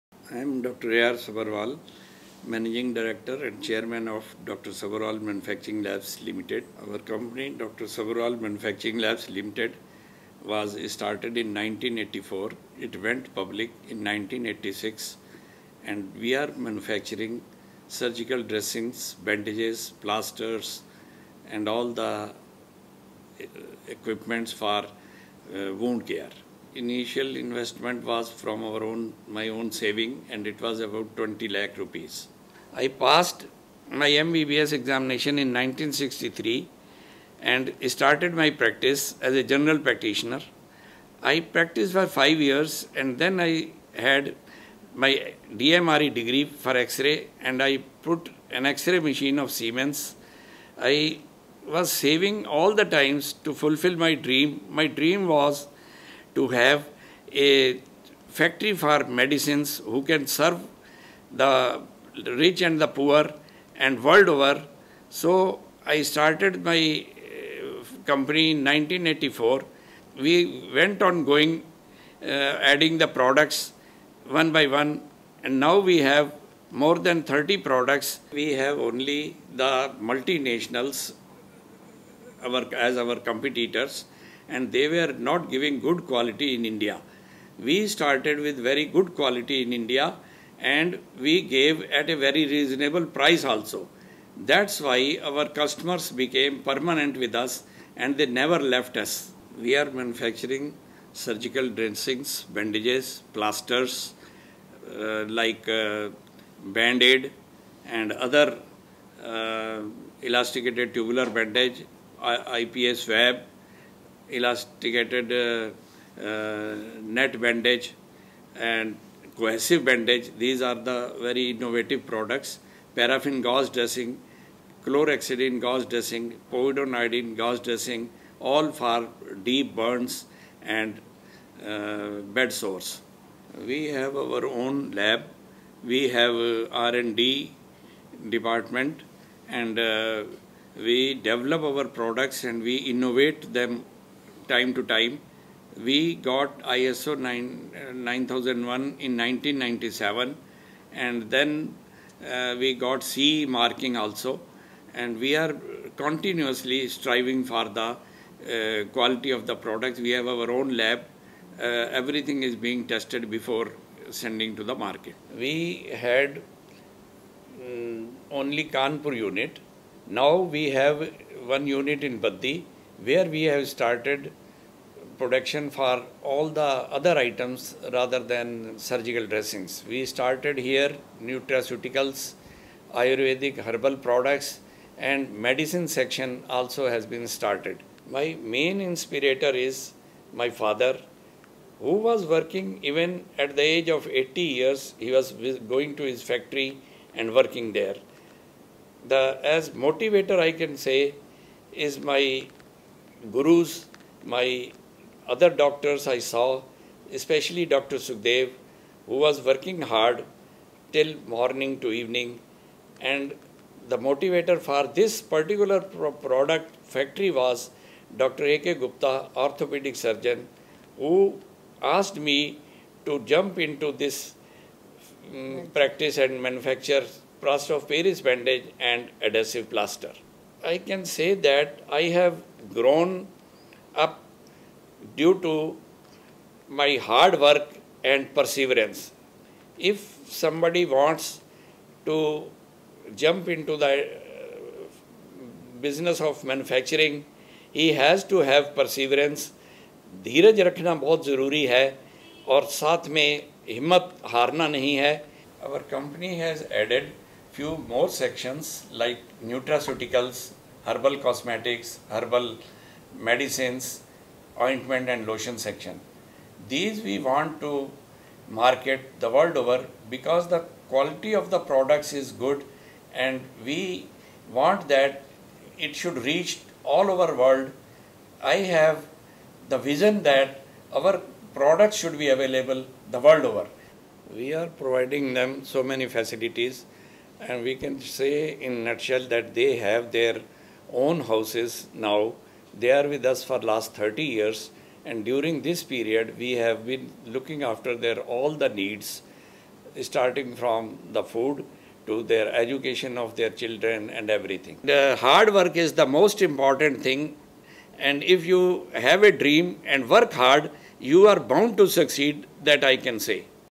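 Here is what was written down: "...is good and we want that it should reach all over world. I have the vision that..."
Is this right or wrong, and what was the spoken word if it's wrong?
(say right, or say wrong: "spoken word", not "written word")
right.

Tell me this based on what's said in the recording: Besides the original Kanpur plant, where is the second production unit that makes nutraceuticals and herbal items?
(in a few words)
Baddi.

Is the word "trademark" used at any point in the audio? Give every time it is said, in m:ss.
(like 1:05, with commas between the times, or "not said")
not said.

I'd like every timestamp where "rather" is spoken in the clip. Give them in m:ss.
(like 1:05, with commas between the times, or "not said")
2:57.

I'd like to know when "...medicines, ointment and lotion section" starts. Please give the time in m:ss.
4:23.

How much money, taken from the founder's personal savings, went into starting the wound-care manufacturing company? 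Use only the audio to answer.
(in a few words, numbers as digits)
20 lakh rupees.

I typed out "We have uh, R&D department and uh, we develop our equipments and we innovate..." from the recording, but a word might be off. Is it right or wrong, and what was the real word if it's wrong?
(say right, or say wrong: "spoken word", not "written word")
wrong: "products", not "equipments".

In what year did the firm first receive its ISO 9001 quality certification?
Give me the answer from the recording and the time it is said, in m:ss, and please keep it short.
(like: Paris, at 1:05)
1997, at 2:29.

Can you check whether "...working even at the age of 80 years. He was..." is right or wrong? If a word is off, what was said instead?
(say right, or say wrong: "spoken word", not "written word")
right.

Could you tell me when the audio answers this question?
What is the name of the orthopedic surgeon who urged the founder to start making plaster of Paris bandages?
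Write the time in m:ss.
3:38.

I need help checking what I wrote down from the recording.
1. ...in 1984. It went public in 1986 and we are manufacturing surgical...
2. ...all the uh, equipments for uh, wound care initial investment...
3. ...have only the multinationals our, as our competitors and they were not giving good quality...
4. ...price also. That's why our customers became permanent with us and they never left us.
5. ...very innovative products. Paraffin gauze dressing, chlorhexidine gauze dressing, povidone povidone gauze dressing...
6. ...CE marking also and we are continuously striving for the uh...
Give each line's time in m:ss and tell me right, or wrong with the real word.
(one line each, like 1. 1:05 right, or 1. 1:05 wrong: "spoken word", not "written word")
1. 0:11 right
2. 0:21 right
3. 1:18 right
4. 1:33 right
5. 2:01 wrong: "iodine", not "povidone"
6. 2:33 right.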